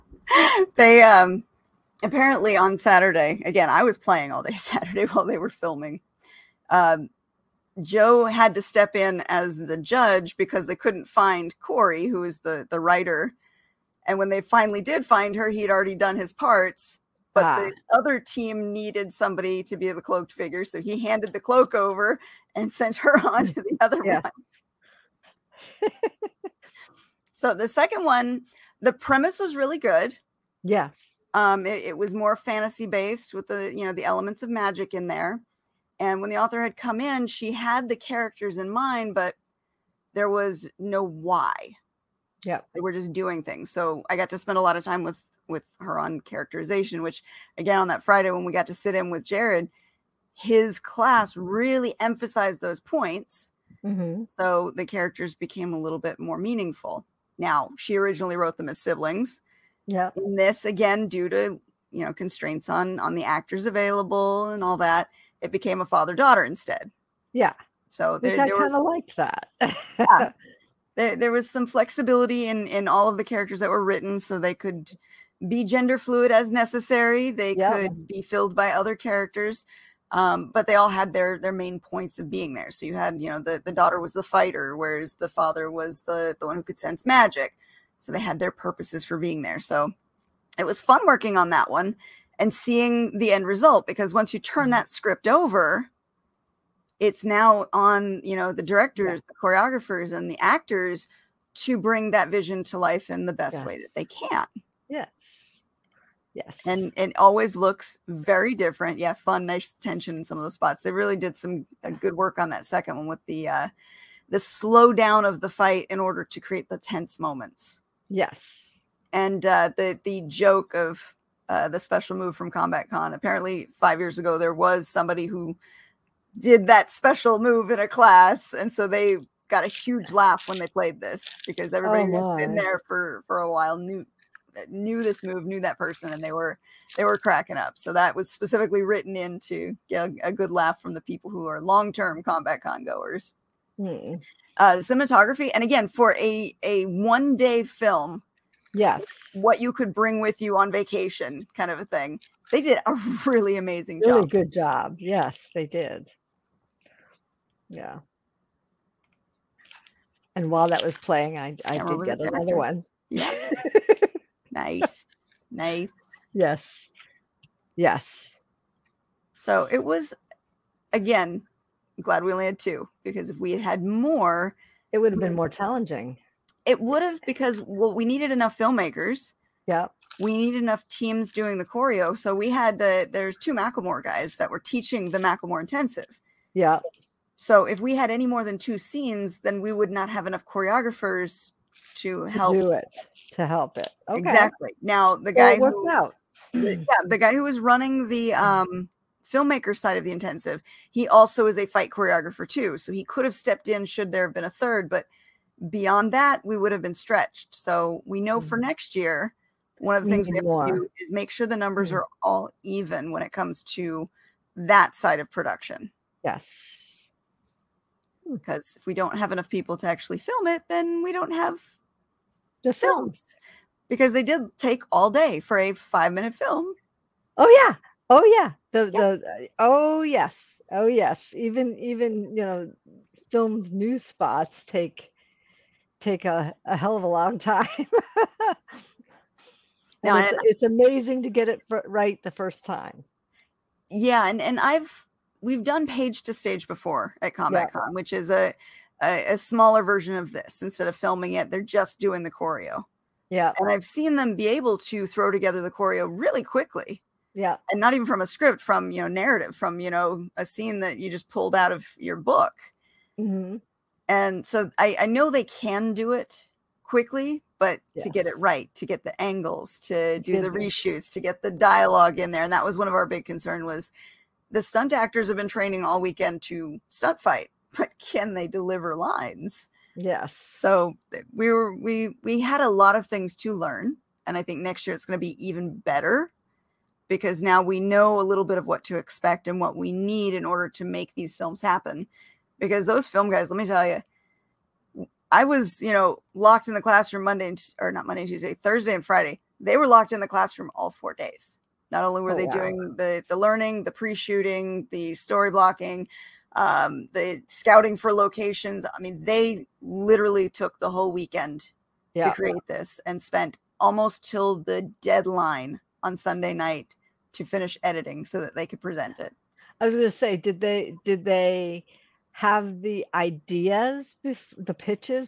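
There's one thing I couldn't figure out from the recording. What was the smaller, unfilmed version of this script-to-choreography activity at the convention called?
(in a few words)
page to stage.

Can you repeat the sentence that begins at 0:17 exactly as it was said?
the other team needed somebody to be the cloaked figure.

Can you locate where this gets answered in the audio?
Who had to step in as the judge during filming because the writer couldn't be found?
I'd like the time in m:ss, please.
0:07.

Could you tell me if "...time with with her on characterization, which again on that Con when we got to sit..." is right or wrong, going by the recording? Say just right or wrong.
wrong.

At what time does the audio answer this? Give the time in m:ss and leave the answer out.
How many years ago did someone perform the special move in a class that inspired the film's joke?
2:03.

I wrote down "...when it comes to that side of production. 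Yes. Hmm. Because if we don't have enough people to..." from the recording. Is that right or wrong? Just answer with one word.
right.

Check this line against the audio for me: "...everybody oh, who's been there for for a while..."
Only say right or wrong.
right.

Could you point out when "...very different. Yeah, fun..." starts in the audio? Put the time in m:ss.
1:48.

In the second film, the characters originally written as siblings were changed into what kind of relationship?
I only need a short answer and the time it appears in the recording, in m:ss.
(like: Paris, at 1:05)
father-daughter, at 1:05.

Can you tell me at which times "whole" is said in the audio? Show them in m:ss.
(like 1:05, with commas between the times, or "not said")
5:10.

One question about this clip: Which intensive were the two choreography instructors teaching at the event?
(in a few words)
Macklemore intensive.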